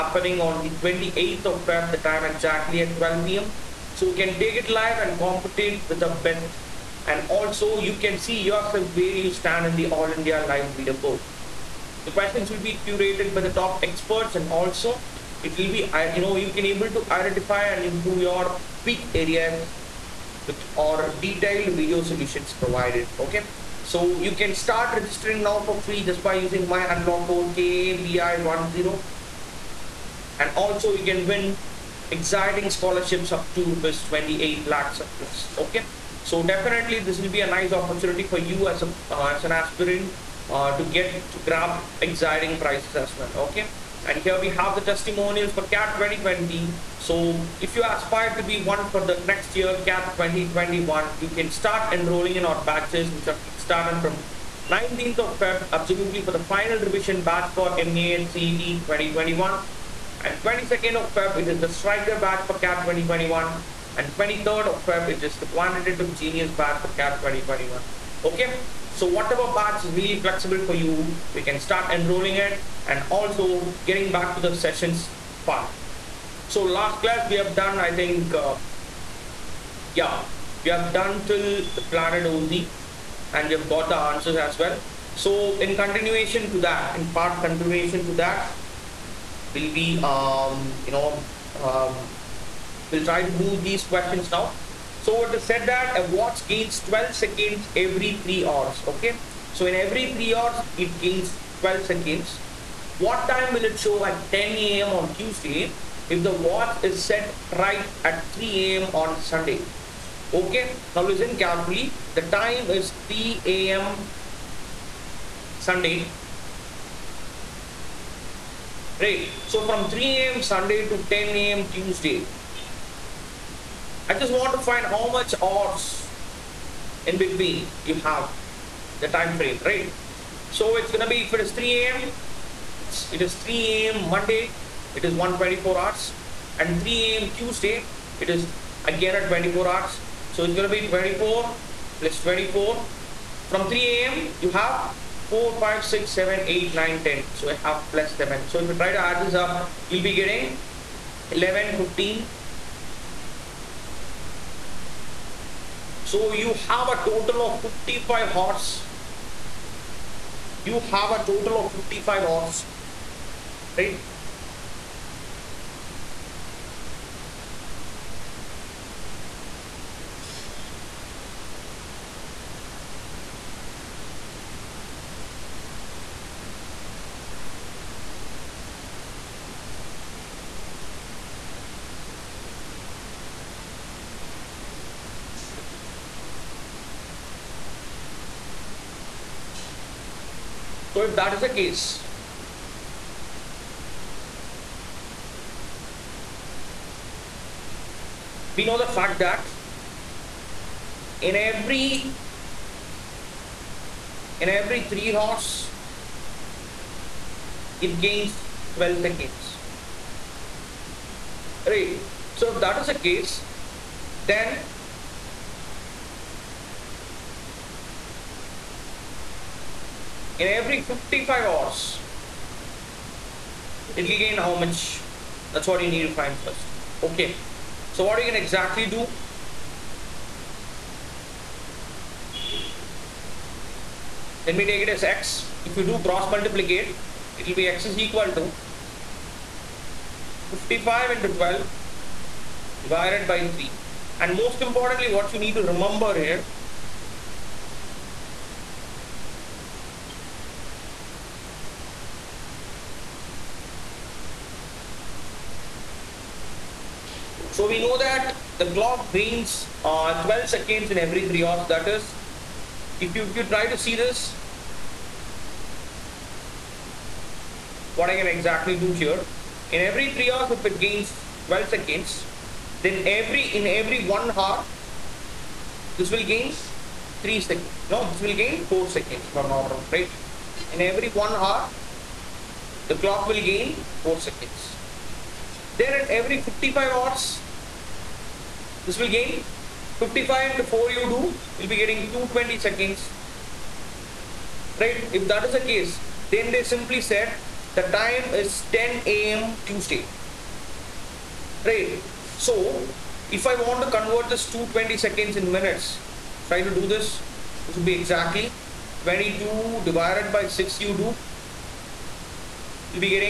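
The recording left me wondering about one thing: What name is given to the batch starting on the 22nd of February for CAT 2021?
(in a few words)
Striker batch.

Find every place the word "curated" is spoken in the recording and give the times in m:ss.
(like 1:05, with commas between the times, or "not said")
0:12.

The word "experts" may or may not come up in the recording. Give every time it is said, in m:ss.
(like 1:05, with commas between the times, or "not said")
0:13.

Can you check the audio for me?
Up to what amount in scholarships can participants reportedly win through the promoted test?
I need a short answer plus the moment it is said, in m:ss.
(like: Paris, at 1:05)
28 lakhs plus, at 0:33.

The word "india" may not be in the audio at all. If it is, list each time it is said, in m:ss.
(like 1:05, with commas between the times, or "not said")
0:10.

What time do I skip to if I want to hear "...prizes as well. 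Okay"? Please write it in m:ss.
0:42.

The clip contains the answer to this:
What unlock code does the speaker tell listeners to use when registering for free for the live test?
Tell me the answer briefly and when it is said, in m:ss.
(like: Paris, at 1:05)
KABI10, at 0:27.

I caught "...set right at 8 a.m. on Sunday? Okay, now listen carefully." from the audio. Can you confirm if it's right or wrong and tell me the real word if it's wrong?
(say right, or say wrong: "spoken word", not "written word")
wrong: "3", not "8".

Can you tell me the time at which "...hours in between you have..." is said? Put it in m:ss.
2:05.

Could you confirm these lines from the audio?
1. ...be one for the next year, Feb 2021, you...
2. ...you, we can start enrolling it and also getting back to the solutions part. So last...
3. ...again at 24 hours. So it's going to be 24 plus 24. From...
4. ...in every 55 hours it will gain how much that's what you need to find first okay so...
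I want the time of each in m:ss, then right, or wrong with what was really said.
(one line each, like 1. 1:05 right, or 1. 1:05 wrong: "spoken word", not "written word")
1. 0:48 wrong: "CAT", not "Feb"
2. 1:10 wrong: "sessions", not "solutions"
3. 2:18 right
4. 3:40 right.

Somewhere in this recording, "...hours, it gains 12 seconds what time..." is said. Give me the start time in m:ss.
1:40.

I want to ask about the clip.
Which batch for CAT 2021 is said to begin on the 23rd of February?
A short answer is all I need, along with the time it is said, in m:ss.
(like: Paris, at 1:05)
Quantitative genius batch, at 1:05.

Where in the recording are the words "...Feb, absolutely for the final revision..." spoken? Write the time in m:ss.
0:55.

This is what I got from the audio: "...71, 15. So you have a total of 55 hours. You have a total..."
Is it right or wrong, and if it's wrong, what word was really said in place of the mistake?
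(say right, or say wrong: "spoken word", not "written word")
wrong: "11", not "71".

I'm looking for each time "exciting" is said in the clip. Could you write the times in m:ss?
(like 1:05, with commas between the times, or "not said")
0:32, 0:41.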